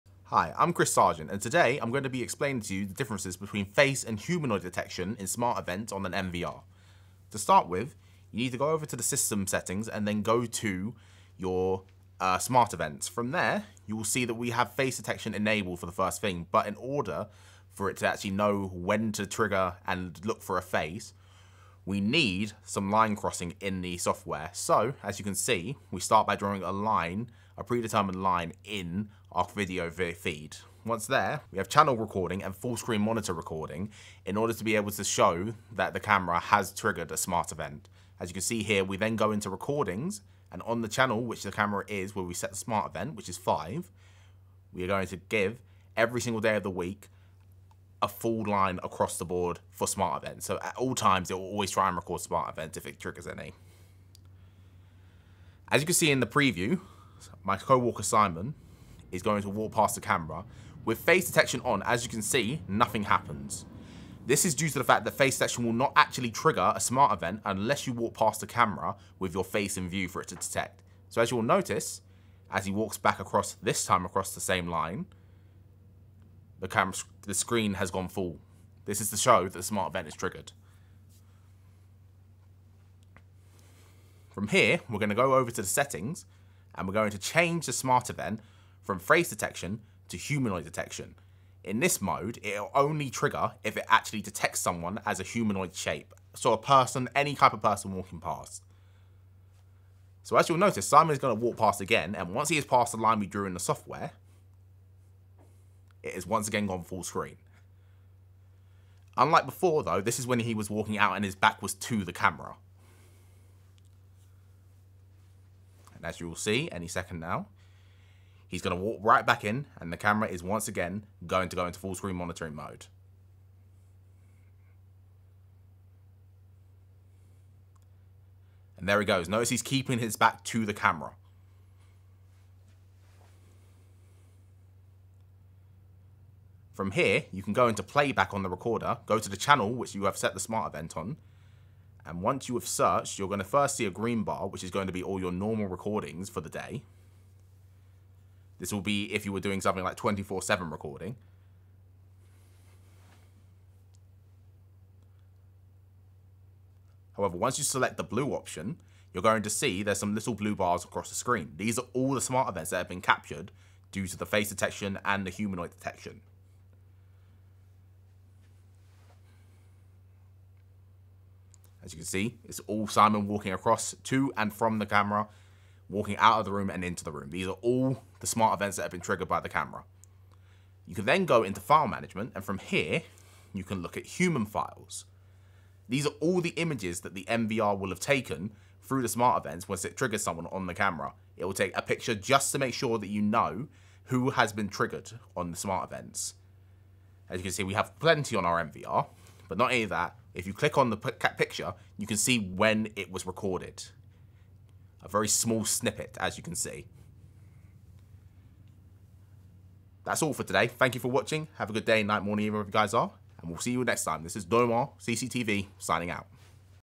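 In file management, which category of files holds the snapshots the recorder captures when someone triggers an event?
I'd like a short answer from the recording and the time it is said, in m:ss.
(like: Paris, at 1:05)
Human files, at 3:04.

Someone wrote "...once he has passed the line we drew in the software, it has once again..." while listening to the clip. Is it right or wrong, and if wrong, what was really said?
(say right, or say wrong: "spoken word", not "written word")
right.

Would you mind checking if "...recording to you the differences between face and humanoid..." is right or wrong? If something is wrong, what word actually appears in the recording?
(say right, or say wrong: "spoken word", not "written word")
wrong: "explaining", not "recording".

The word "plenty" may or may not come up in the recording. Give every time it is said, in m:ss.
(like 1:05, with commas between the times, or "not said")
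3:17.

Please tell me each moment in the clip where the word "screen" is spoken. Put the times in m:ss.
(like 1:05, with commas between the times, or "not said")
0:32, 1:17, 1:47, 2:01, 2:41.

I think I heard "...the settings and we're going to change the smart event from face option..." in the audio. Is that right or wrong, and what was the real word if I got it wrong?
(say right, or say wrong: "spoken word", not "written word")
wrong: "detection", not "option".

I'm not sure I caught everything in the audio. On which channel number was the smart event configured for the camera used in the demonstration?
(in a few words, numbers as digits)
5.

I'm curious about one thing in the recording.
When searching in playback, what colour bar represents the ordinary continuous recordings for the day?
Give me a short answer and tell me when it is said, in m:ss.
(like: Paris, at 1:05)
Green, at 2:23.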